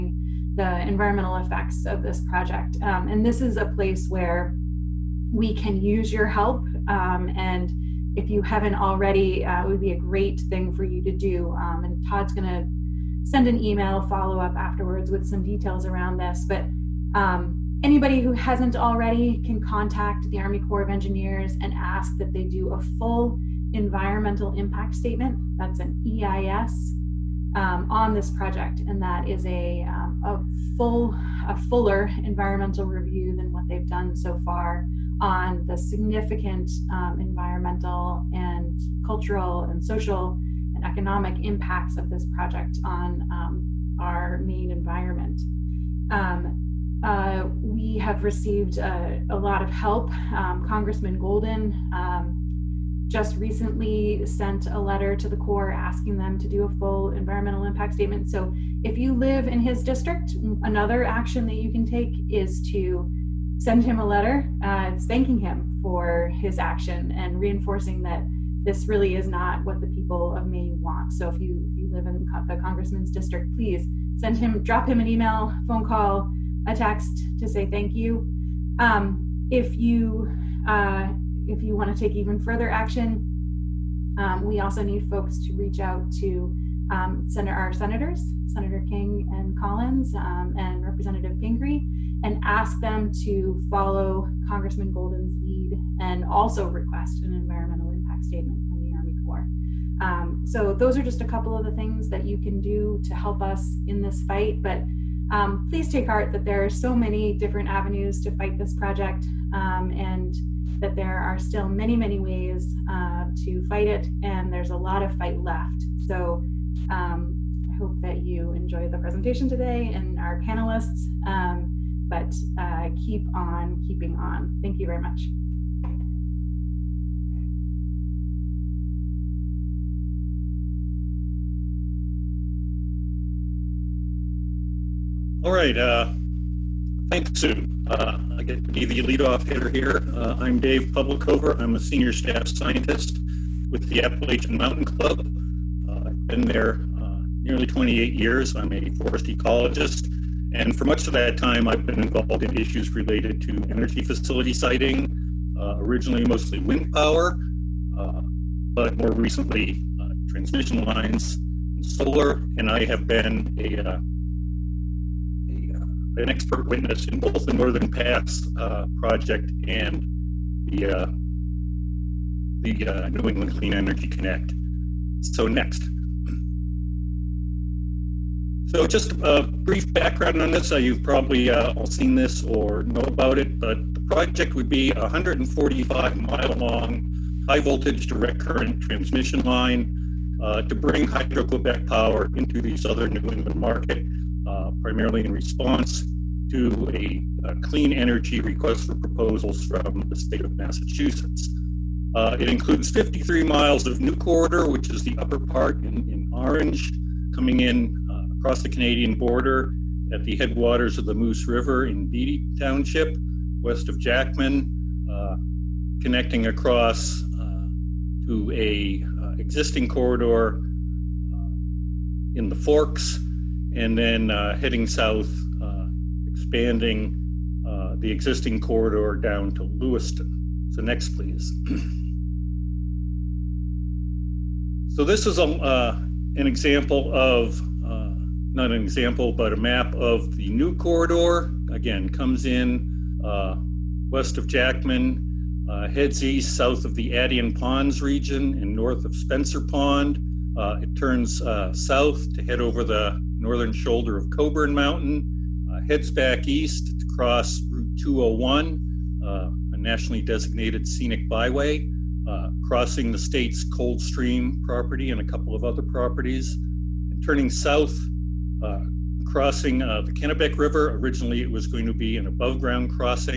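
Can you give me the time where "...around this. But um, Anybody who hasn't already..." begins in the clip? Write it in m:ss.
0:15.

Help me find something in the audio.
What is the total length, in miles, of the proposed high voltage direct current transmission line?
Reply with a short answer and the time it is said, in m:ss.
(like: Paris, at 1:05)
145, at 3:05.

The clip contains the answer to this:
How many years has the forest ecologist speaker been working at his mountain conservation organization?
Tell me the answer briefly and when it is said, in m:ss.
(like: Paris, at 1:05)
28, at 2:27.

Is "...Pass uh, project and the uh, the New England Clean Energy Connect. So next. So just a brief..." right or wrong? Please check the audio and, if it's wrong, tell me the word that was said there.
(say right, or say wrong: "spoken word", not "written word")
right.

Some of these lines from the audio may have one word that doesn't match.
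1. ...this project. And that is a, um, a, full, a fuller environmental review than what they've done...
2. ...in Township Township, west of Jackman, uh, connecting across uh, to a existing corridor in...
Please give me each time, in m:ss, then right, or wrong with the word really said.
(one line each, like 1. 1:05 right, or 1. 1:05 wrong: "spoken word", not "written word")
1. 0:28 right
2. 3:31 wrong: "Beattie", not "Township".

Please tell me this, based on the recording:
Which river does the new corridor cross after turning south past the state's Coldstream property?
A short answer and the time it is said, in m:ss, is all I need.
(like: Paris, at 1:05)
Kennebec River, at 4:30.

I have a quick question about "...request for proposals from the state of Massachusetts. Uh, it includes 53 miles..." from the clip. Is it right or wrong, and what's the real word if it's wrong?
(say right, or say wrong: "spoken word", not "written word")
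right.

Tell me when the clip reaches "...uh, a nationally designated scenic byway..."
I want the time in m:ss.
4:19.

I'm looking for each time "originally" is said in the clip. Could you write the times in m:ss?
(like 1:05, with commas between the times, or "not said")
2:35, 4:30.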